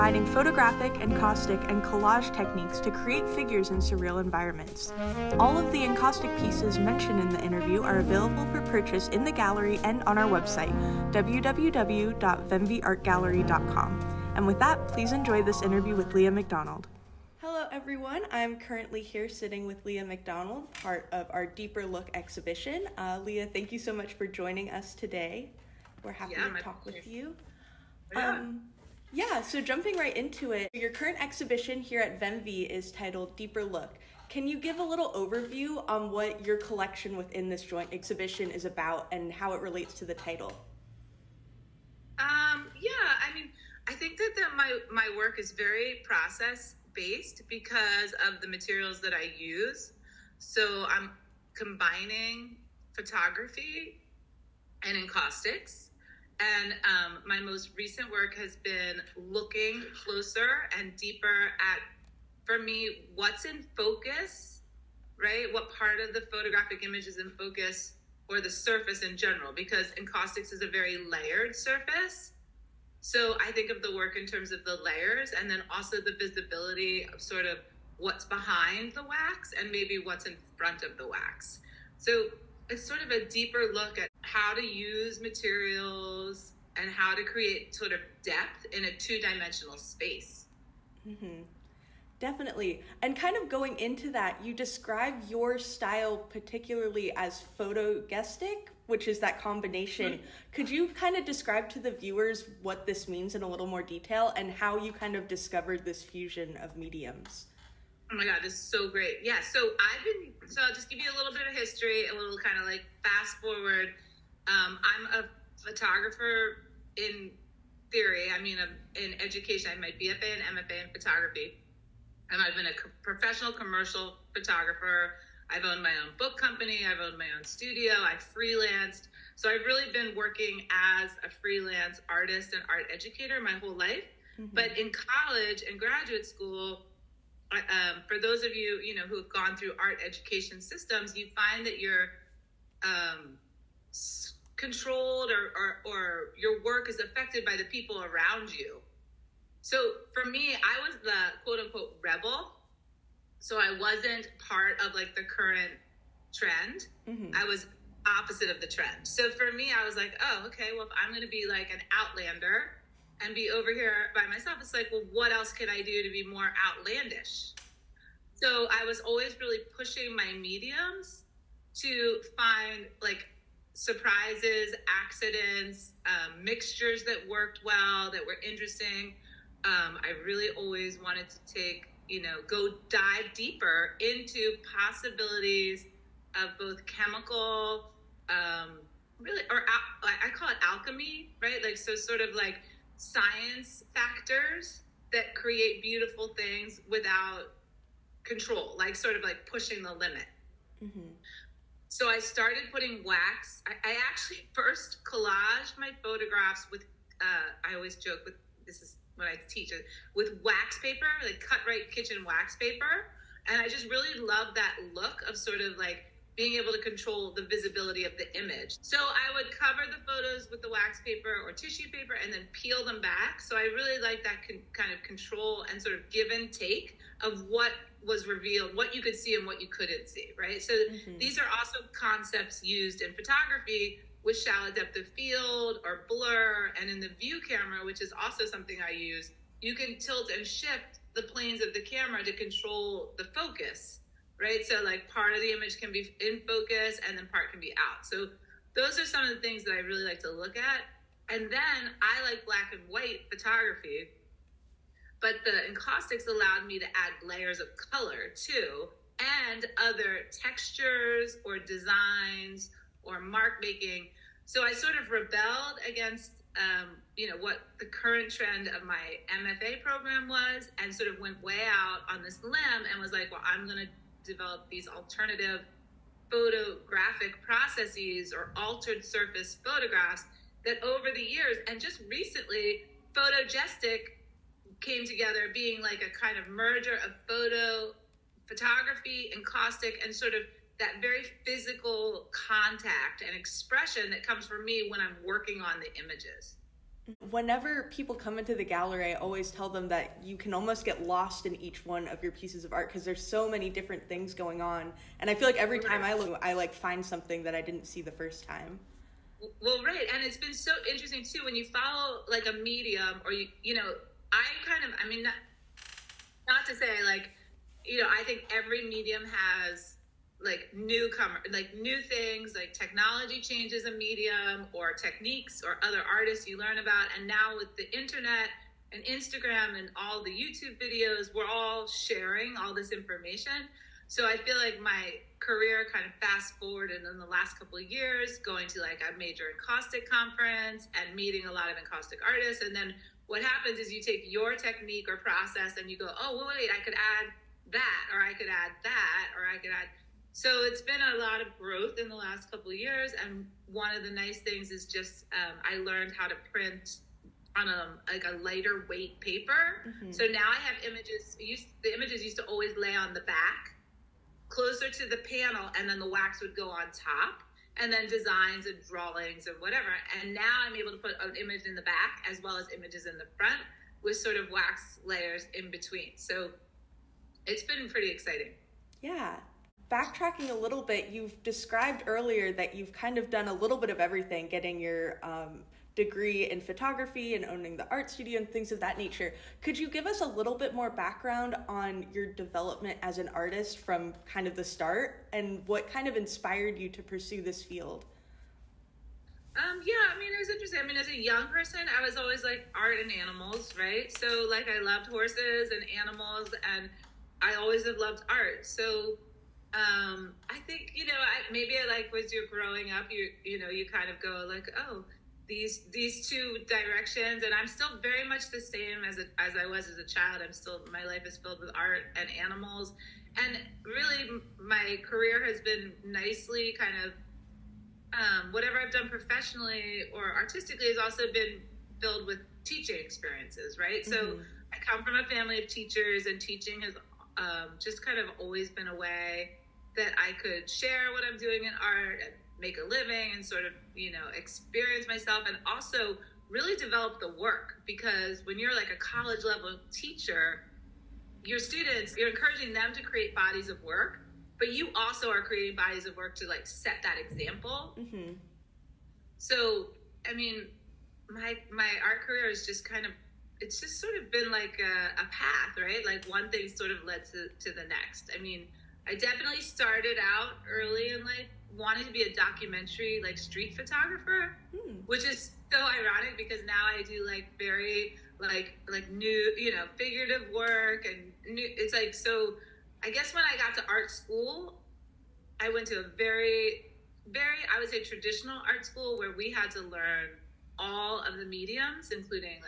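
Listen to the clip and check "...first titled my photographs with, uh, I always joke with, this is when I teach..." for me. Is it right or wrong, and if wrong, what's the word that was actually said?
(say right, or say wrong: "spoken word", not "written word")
wrong: "collaged", not "titled".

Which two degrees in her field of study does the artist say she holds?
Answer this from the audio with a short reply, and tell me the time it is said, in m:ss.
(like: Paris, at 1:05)
BFA and MFA, at 1:59.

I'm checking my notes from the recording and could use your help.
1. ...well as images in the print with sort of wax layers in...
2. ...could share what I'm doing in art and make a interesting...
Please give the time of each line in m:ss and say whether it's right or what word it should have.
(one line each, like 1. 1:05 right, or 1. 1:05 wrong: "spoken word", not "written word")
1. 6:12 wrong: "front", not "print"
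2. 7:20 wrong: "living", not "interesting".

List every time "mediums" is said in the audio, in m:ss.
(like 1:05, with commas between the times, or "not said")
1:46, 2:50, 5:12, 5:18, 5:23, 8:11.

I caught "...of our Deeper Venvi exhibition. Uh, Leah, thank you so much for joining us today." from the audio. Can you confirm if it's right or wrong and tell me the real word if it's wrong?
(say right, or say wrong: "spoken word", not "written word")
wrong: "Look", not "Venvi".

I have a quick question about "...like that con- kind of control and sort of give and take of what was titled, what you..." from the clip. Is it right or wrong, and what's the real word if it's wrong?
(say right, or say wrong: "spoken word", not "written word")
wrong: "revealed", not "titled".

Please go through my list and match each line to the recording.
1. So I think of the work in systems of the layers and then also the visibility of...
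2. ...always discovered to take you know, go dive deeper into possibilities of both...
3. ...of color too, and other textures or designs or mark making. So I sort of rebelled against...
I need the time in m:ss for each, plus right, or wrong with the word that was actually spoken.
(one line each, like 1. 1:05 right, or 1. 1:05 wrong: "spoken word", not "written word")
1. 1:13 wrong: "terms", not "systems"
2. 3:00 wrong: "wanted", not "discovered"
3. 4:17 right.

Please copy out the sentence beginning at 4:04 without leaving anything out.
So, like, part of the image can be in focus and then part can be out.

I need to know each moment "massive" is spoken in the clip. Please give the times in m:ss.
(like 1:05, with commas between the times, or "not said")
not said.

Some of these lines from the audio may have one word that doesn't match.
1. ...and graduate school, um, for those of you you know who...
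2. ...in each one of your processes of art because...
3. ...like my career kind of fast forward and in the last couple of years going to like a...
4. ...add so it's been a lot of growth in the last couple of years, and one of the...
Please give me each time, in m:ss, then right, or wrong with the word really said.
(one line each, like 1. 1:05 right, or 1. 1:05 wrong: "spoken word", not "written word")
1. 2:15 right
2. 5:01 wrong: "pieces", not "processes"
3. 5:34 right
4. 5:49 right.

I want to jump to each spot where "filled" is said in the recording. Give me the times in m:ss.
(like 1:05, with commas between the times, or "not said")
7:01, 7:12.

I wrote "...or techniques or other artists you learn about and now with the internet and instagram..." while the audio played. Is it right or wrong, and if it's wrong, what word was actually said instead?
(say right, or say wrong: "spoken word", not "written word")
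right.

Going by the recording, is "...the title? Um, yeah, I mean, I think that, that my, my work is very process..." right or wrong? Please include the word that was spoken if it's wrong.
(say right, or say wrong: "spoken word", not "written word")
right.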